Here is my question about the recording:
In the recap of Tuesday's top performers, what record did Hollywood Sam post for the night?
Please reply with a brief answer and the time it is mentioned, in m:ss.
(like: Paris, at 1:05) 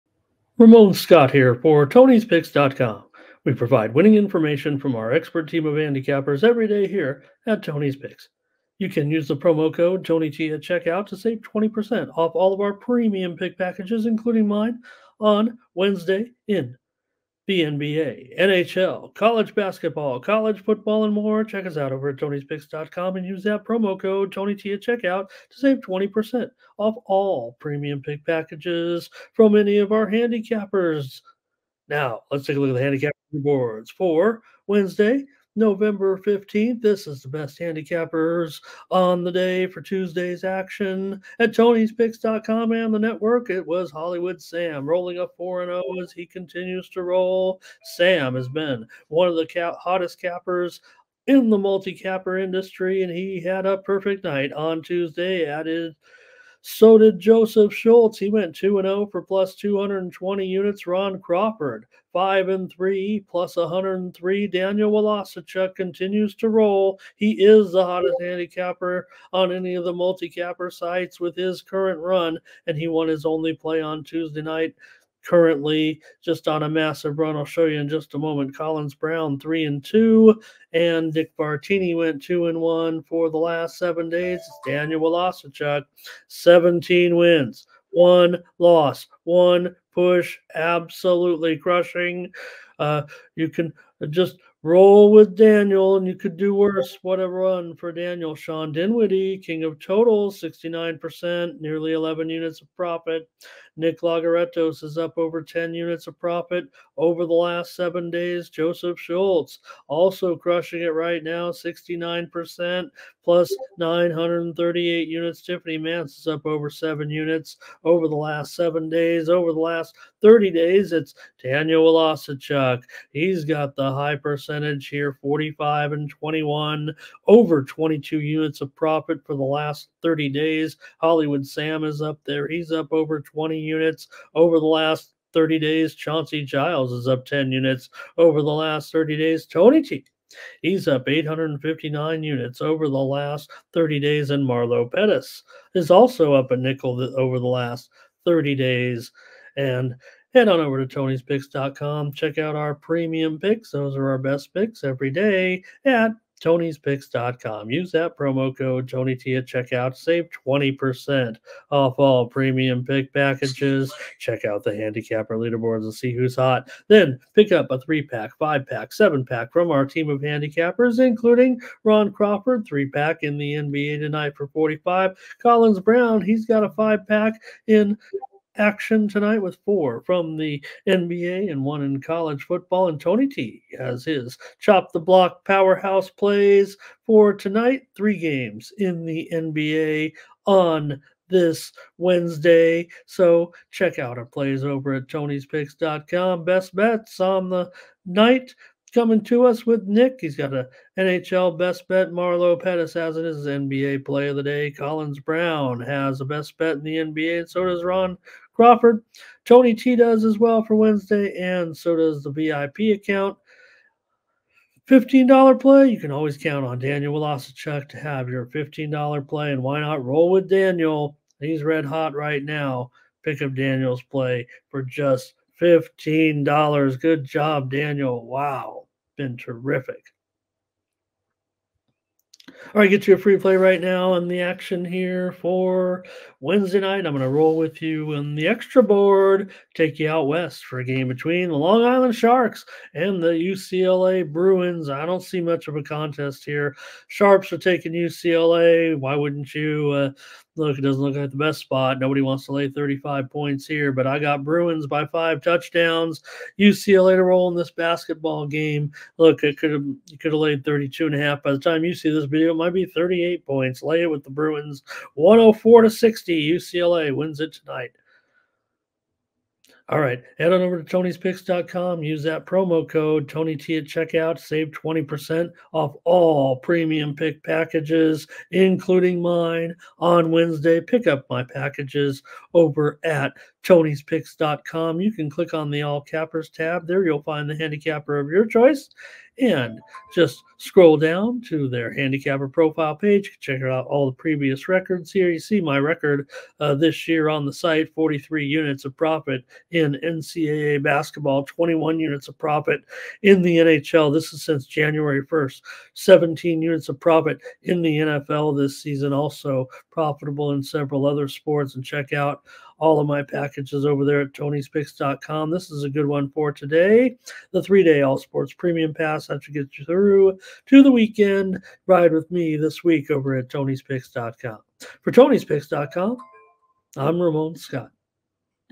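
4-0, at 0:45.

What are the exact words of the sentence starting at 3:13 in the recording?
So check out our plays over at tonyspicks.com.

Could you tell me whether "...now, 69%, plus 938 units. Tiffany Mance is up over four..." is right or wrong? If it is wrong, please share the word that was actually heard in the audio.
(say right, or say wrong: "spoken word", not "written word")
wrong: "seven", not "four".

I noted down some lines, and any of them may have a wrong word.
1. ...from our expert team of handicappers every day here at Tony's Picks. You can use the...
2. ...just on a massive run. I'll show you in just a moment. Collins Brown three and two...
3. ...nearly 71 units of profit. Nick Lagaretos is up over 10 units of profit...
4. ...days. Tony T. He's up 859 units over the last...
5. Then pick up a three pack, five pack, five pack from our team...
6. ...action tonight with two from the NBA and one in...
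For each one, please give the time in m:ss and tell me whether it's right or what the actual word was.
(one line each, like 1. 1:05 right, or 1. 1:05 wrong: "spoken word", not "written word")
1. 0:04 right
2. 1:16 right
3. 1:41 wrong: "11", not "71"
4. 2:19 right
5. 2:46 wrong: "seven", not "five"
6. 2:58 wrong: "four", not "two".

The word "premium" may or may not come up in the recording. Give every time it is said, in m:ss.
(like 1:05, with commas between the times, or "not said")
0:12, 0:27, 2:32, 2:42, 4:36, 5:18.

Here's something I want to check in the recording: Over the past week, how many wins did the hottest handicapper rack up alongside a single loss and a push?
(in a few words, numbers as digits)
17.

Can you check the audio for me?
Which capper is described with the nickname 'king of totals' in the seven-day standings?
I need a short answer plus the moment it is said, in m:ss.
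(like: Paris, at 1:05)
Sean Dinwiddie, at 1:38.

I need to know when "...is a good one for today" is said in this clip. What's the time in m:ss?
5:15.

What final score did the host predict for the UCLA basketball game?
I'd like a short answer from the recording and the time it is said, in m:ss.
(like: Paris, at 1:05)
104 to 60, at 4:25.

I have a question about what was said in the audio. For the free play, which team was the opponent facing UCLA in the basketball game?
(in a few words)
Long Island Sharks.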